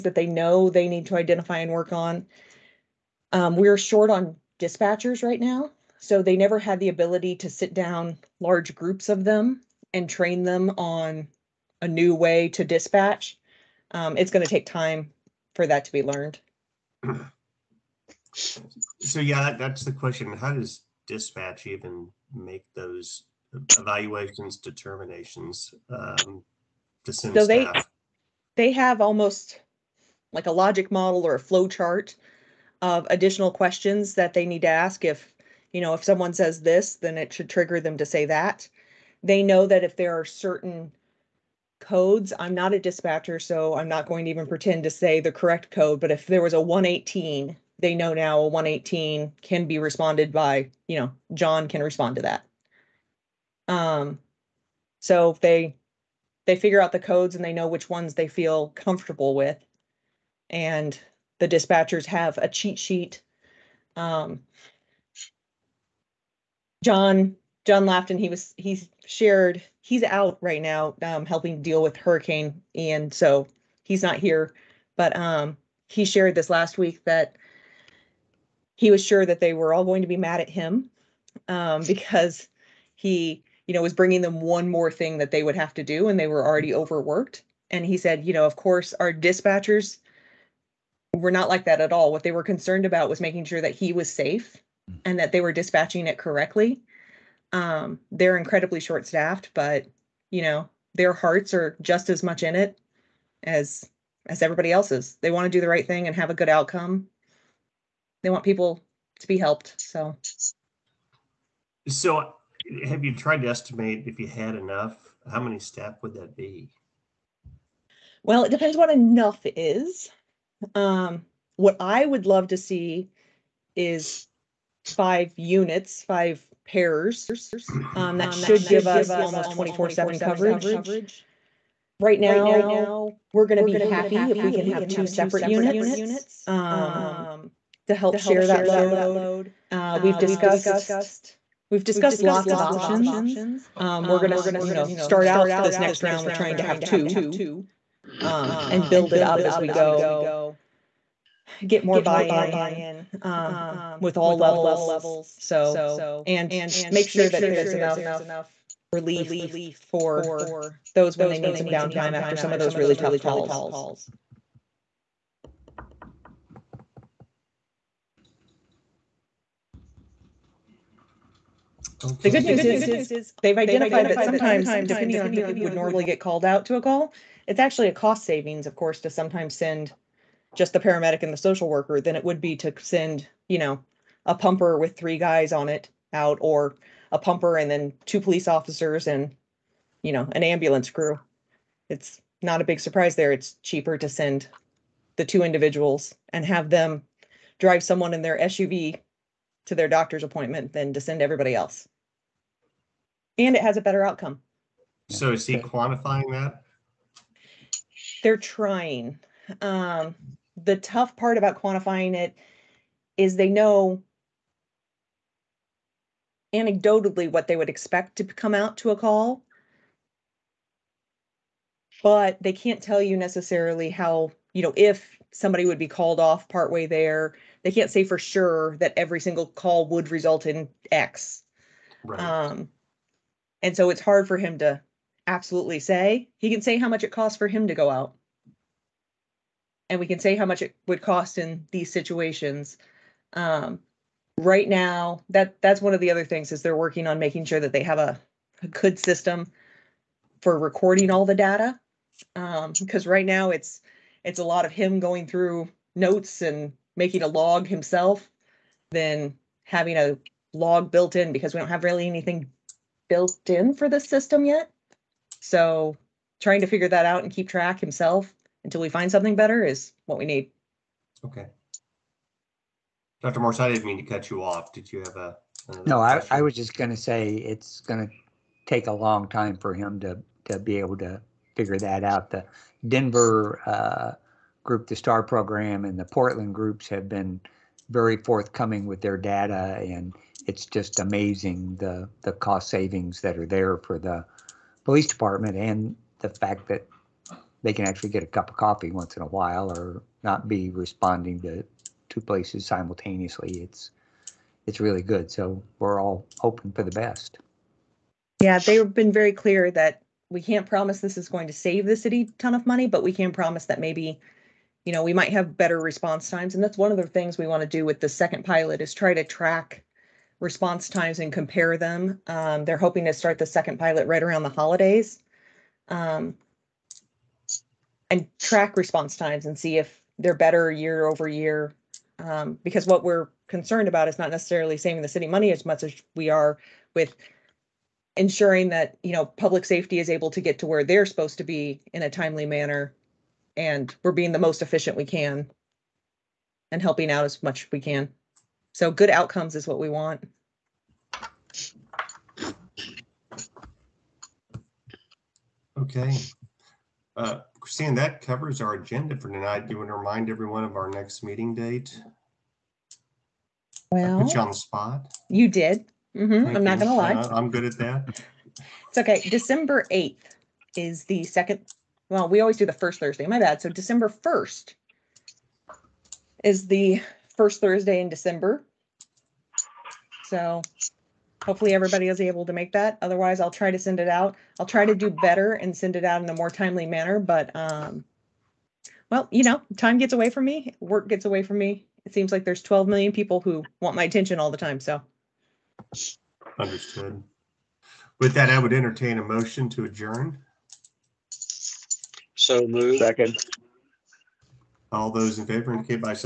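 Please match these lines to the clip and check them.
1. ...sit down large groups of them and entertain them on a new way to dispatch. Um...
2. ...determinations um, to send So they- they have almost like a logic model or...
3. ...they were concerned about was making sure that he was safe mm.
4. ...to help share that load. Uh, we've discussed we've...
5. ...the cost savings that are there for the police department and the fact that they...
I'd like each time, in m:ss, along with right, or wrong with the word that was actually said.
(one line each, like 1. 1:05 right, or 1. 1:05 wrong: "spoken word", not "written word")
1. 0:07 wrong: "train", not "entertain"
2. 0:24 right
3. 1:32 right
4. 2:17 right
5. 4:52 right.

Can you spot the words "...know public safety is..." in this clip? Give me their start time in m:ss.
5:39.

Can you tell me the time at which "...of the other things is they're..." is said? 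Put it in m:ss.
4:05.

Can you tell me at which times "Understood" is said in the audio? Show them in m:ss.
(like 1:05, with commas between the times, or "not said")
6:36.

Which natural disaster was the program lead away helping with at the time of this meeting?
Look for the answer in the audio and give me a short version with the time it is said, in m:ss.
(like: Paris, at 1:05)
Hurricane Ian, at 1:11.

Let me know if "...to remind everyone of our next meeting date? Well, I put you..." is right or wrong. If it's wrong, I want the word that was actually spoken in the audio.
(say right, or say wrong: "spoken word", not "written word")
right.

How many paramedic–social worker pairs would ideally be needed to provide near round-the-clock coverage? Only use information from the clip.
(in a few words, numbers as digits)
5.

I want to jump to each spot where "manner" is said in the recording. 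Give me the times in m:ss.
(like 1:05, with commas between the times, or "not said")
5:42, 6:26.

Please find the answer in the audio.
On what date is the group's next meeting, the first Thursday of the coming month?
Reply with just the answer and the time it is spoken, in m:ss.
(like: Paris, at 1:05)
December 1, at 6:13.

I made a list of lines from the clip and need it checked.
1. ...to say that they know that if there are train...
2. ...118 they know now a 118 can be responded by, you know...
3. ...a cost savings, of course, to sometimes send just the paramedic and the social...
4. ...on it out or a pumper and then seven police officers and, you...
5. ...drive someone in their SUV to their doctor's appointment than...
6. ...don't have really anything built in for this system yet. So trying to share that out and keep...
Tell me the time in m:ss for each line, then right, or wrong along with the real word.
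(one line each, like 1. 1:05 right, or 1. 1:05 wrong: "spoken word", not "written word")
1. 0:37 wrong: "certain", not "train"
2. 0:46 right
3. 2:57 right
4. 3:05 wrong: "two", not "seven"
5. 3:17 right
6. 4:21 wrong: "figure", not "share".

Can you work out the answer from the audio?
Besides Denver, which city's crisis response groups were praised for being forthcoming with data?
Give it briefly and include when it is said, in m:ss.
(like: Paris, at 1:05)
Portland, at 4:46.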